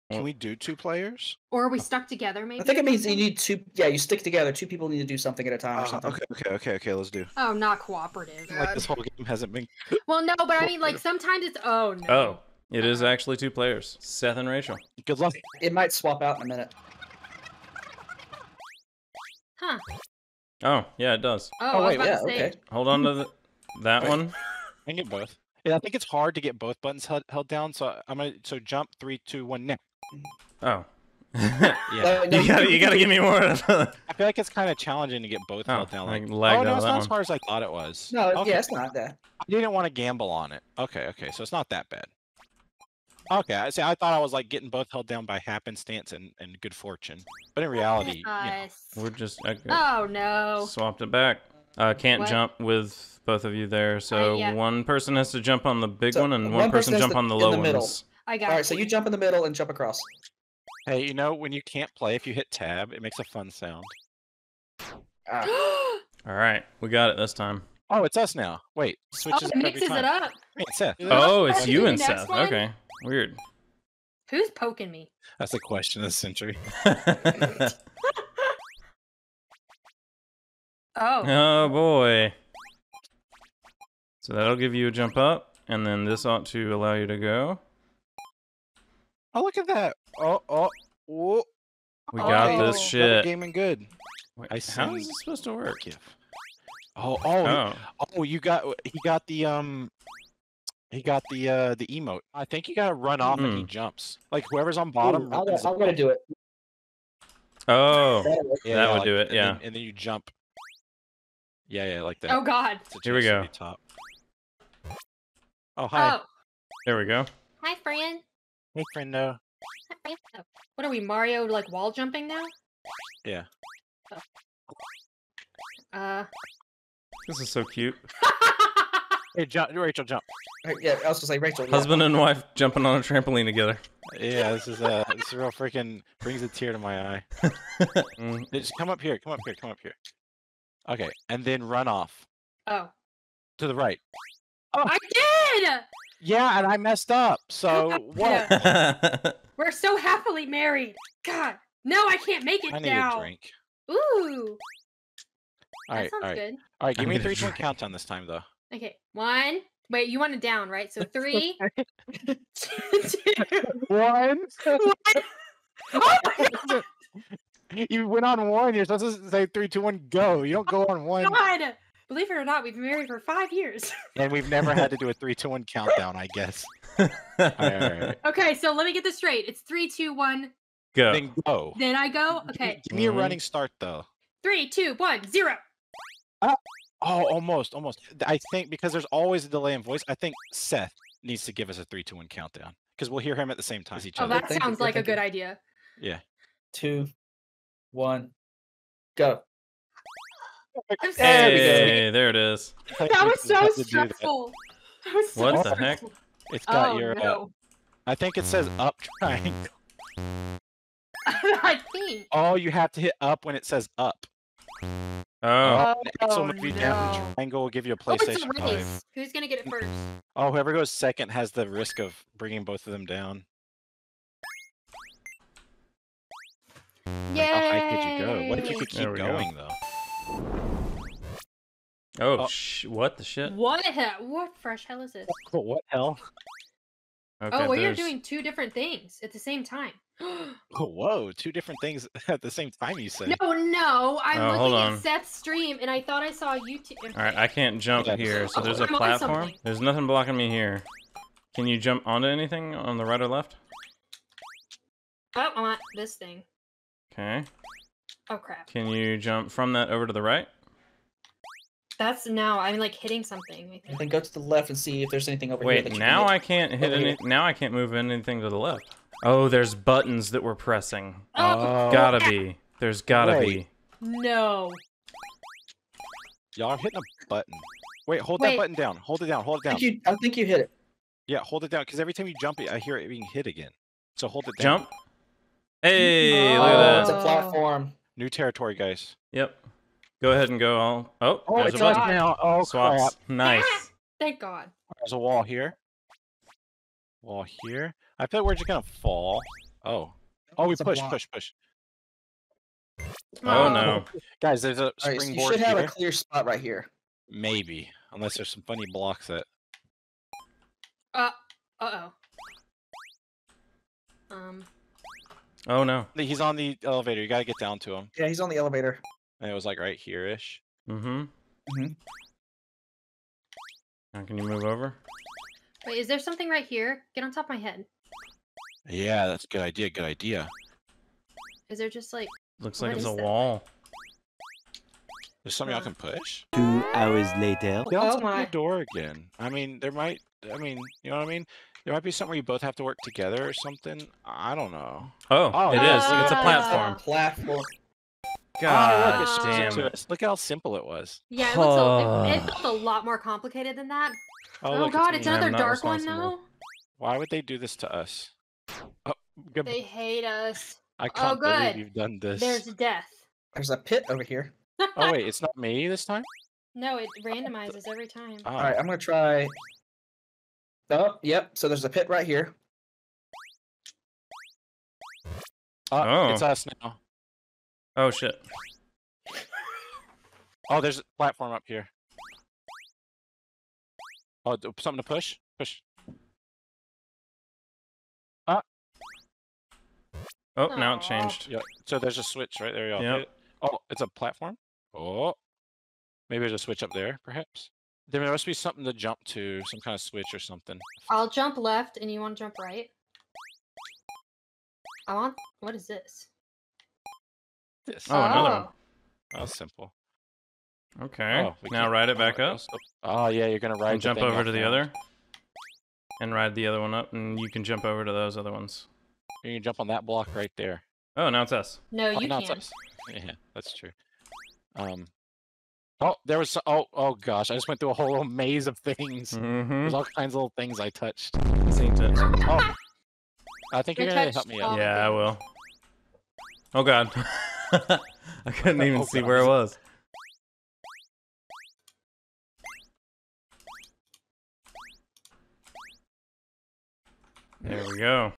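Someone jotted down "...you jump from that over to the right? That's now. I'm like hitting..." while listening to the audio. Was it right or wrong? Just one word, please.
right.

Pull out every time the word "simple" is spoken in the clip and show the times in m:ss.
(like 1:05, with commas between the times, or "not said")
5:50, 6:49.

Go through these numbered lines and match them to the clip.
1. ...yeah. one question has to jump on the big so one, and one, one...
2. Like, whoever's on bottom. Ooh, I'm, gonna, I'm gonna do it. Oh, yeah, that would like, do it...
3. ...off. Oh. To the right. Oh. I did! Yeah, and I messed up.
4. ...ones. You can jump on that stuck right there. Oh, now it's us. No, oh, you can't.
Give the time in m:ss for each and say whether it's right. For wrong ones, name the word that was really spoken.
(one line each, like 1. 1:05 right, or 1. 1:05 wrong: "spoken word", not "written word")
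1. 0:54 wrong: "person", not "question"
2. 1:44 right
3. 2:21 right
4. 6:58 wrong: "block", not "stuck".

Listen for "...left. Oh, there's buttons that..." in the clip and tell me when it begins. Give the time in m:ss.
4:28.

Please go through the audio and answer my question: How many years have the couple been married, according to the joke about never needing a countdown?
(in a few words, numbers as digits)
5.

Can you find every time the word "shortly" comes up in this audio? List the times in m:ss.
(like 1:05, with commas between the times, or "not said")
not said.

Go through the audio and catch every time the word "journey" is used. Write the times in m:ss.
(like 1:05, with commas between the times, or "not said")
not said.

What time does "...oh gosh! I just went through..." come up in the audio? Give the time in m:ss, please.
7:06.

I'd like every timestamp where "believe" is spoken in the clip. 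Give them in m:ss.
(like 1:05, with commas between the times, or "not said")
2:52, 6:01.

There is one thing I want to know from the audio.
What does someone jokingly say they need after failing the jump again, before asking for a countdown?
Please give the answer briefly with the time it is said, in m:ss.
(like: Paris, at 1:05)
A drink, at 2:33.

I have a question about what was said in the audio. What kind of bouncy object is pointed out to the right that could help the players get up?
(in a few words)
A springboard.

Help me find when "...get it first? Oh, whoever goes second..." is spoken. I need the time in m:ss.
3:39.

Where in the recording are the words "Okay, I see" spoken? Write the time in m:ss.
0:43.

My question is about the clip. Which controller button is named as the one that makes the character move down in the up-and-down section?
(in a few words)
X.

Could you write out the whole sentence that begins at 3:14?
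Oh, that sounds like a good idea.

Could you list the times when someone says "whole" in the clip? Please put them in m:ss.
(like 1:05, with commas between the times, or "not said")
0:08, 7:07.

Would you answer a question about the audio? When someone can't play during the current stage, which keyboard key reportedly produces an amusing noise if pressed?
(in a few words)
Tab.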